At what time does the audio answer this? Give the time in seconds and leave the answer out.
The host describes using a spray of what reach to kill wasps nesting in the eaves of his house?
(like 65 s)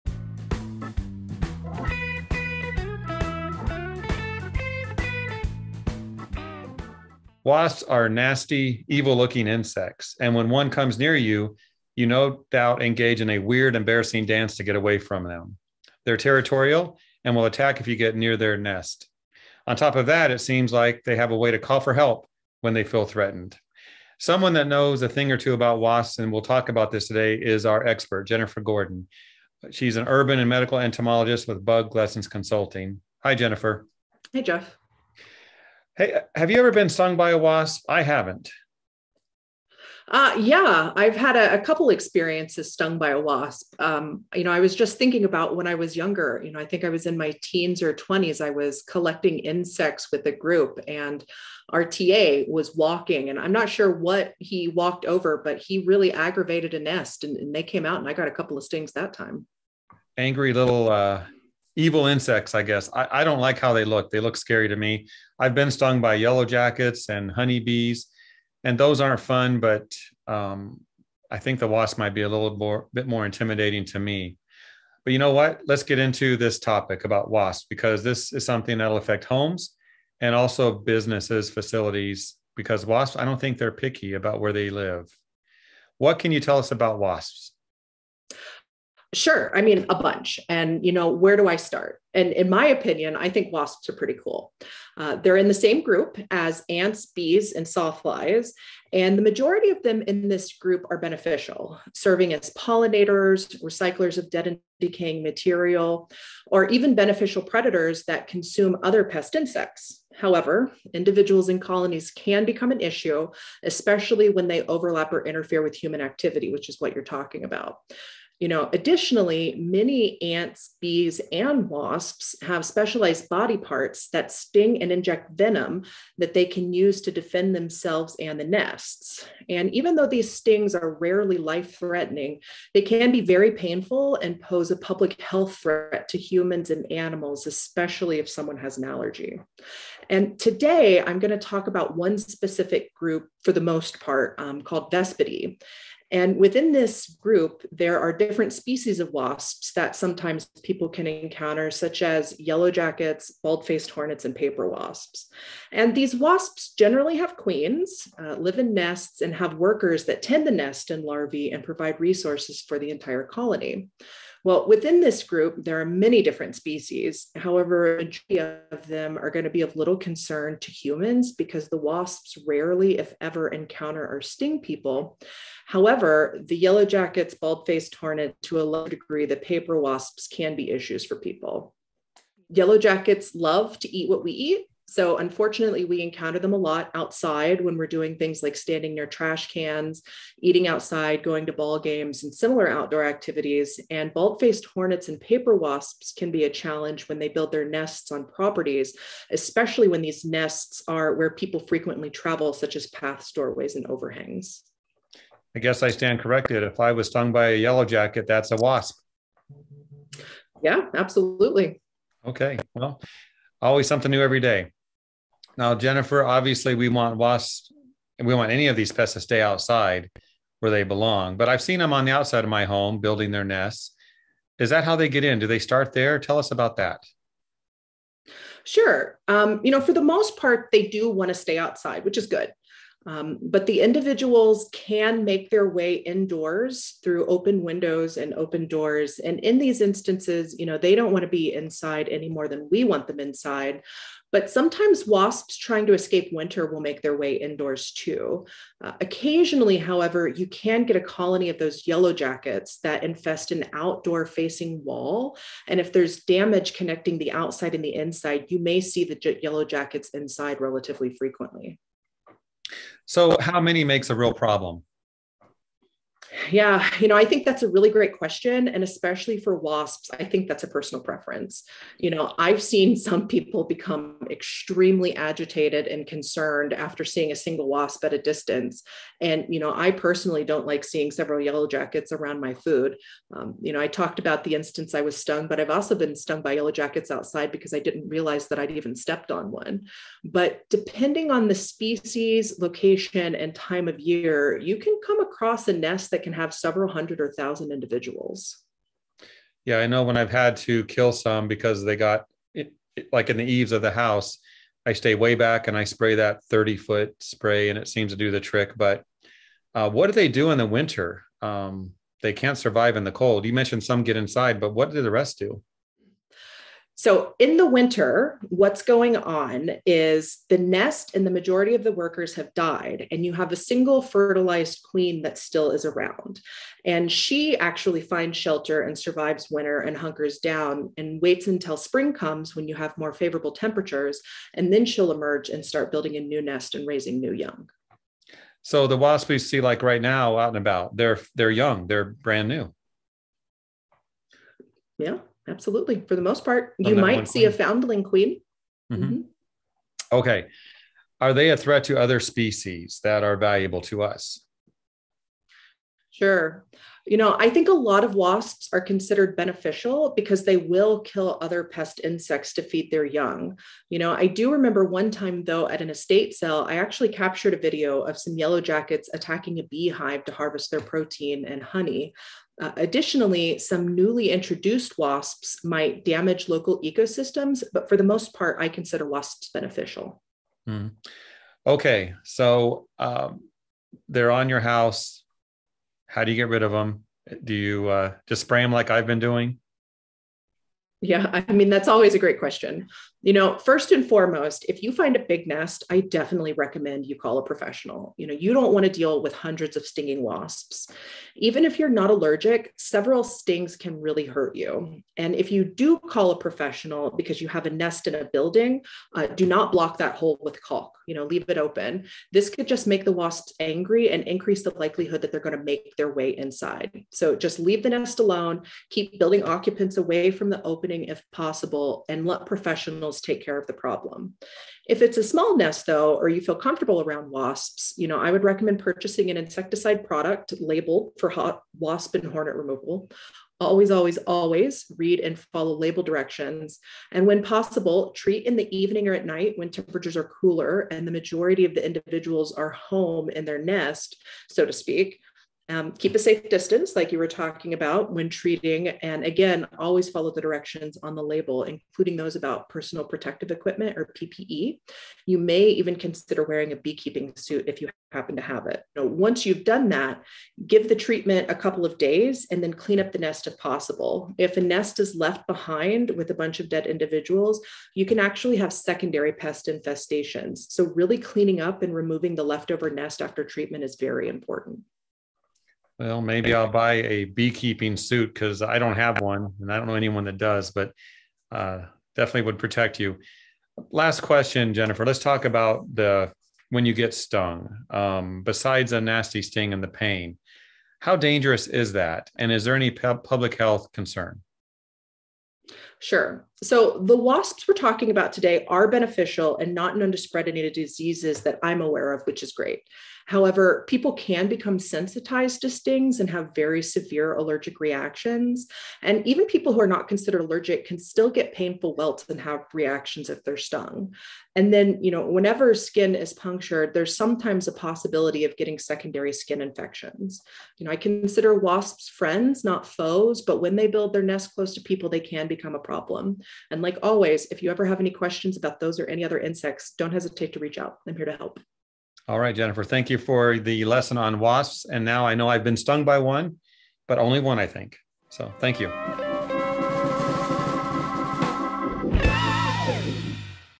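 306 s.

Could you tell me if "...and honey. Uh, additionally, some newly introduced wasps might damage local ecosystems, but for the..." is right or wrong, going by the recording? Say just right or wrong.
right.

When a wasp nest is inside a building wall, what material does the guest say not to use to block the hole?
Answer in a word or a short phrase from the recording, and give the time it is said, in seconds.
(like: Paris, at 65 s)
Caulk, at 410 s.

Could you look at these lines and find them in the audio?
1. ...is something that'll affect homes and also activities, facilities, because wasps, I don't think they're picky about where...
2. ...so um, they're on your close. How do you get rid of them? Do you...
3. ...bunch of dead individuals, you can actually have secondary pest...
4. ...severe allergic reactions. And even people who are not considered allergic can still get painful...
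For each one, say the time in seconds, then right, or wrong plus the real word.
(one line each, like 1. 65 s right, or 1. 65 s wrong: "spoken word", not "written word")
1. 78 s wrong: "businesses", not "activities"
2. 382 s wrong: "house", not "close"
3. 466 s right
4. 506 s right.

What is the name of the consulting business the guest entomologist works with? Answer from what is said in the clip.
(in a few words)
Bug Lessons Consulting.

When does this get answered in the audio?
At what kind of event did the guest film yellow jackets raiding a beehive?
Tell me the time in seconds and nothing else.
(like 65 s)
365 s.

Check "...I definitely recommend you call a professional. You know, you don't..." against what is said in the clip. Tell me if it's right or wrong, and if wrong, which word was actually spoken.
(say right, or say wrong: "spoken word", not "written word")
right.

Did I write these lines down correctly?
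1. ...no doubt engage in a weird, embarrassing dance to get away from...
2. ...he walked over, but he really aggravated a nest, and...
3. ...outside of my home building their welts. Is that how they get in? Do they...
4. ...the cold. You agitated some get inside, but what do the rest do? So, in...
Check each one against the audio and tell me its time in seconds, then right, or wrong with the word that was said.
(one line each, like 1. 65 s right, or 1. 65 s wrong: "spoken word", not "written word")
1. 12 s right
2. 54 s right
3. 222 s wrong: "nests", not "welts"
4. 313 s wrong: "mentioned", not "agitated".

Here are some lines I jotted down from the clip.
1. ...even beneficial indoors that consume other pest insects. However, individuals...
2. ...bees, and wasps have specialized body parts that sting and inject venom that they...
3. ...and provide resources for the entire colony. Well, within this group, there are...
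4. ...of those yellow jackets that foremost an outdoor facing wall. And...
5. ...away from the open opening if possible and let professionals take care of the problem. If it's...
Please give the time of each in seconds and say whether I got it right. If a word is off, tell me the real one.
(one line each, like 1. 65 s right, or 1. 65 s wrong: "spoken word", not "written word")
1. 106 s wrong: "predators", not "indoors"
2. 120 s right
3. 161 s right
4. 251 s wrong: "infest", not "foremost"
5. 419 s right.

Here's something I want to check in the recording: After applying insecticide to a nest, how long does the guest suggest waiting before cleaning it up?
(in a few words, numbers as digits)
A couple of days.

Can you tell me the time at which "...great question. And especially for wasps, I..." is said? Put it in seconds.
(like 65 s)
267 s.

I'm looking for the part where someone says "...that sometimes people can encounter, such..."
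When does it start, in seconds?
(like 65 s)
149 s.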